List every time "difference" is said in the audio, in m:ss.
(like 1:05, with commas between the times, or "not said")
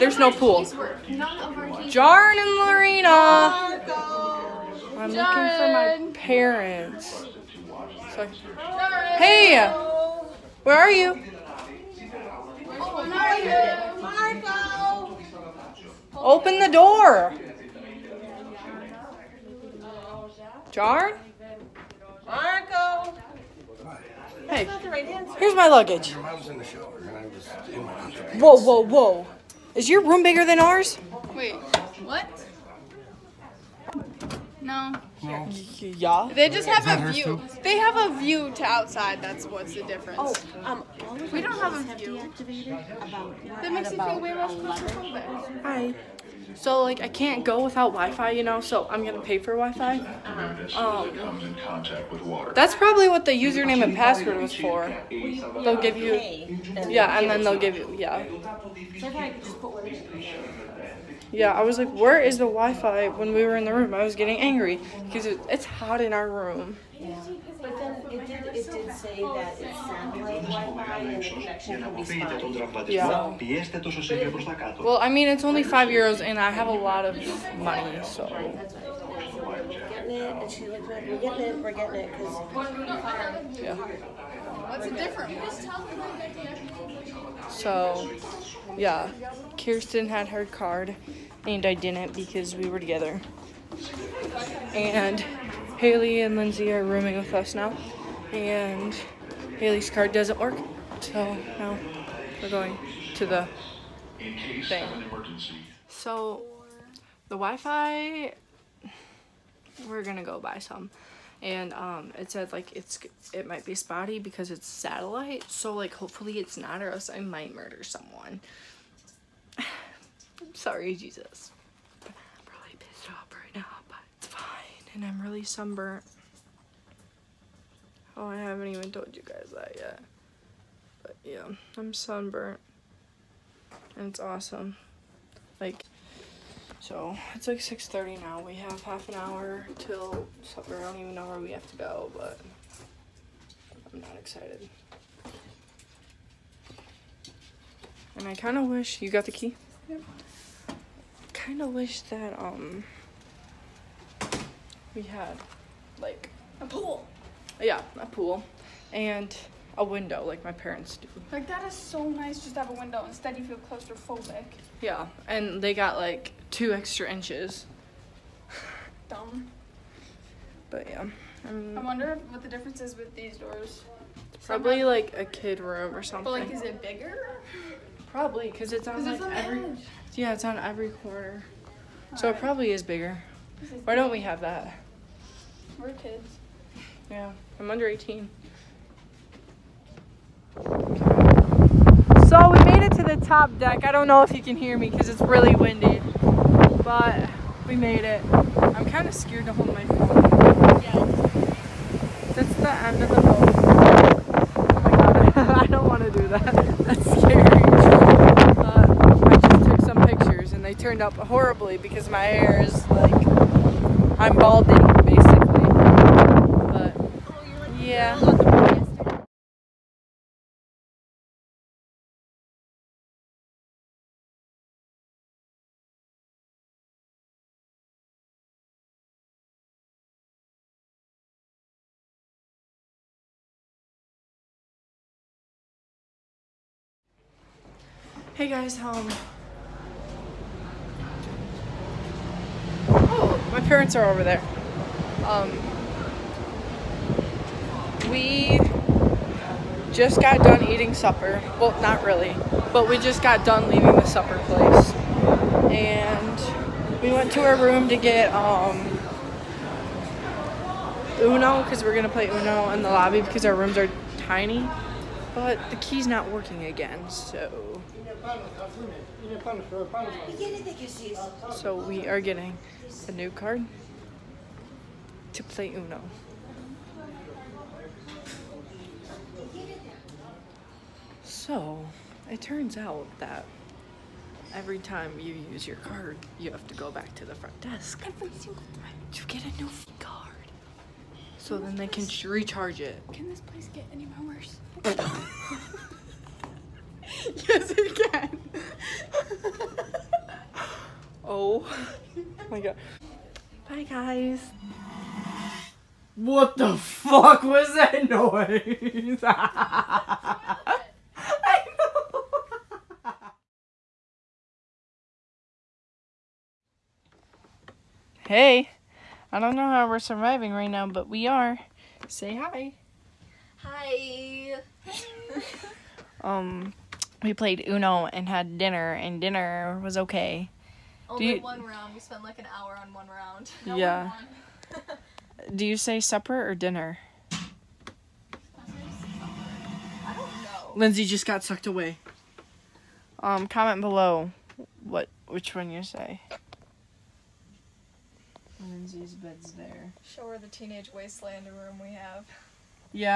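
0:39, 1:24, 2:52.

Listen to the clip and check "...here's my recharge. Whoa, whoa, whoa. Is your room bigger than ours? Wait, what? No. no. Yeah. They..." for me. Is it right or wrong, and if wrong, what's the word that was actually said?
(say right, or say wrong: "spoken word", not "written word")
wrong: "luggage", not "recharge".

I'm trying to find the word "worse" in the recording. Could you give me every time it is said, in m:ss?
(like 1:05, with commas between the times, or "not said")
4:54.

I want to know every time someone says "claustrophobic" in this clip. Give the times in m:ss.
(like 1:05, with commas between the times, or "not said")
0:44, 2:43.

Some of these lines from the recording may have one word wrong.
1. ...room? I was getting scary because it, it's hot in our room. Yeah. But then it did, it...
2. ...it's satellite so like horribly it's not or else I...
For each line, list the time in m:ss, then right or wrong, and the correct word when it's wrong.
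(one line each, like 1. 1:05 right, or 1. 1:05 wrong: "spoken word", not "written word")
1. 1:03 wrong: "angry", not "scary"
2. 1:54 wrong: "hopefully", not "horribly".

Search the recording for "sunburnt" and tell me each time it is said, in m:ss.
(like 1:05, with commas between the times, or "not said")
2:05, 2:11.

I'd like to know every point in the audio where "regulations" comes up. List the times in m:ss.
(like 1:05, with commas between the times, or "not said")
not said.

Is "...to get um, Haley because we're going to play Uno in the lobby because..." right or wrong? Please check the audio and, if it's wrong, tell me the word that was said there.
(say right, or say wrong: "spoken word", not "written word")
wrong: "Uno", not "Haley".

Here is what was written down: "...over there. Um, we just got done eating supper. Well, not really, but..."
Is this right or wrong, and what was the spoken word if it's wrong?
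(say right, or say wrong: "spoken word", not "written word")
right.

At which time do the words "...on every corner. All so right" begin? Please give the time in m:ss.
3:00.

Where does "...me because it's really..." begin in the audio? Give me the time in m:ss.
3:14.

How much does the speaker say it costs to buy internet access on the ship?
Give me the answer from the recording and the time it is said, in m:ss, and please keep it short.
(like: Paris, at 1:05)
5 euros, at 1:15.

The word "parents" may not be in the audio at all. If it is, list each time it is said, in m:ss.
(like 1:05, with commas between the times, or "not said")
0:06, 2:40, 4:03.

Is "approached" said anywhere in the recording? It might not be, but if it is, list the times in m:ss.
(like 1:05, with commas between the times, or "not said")
not said.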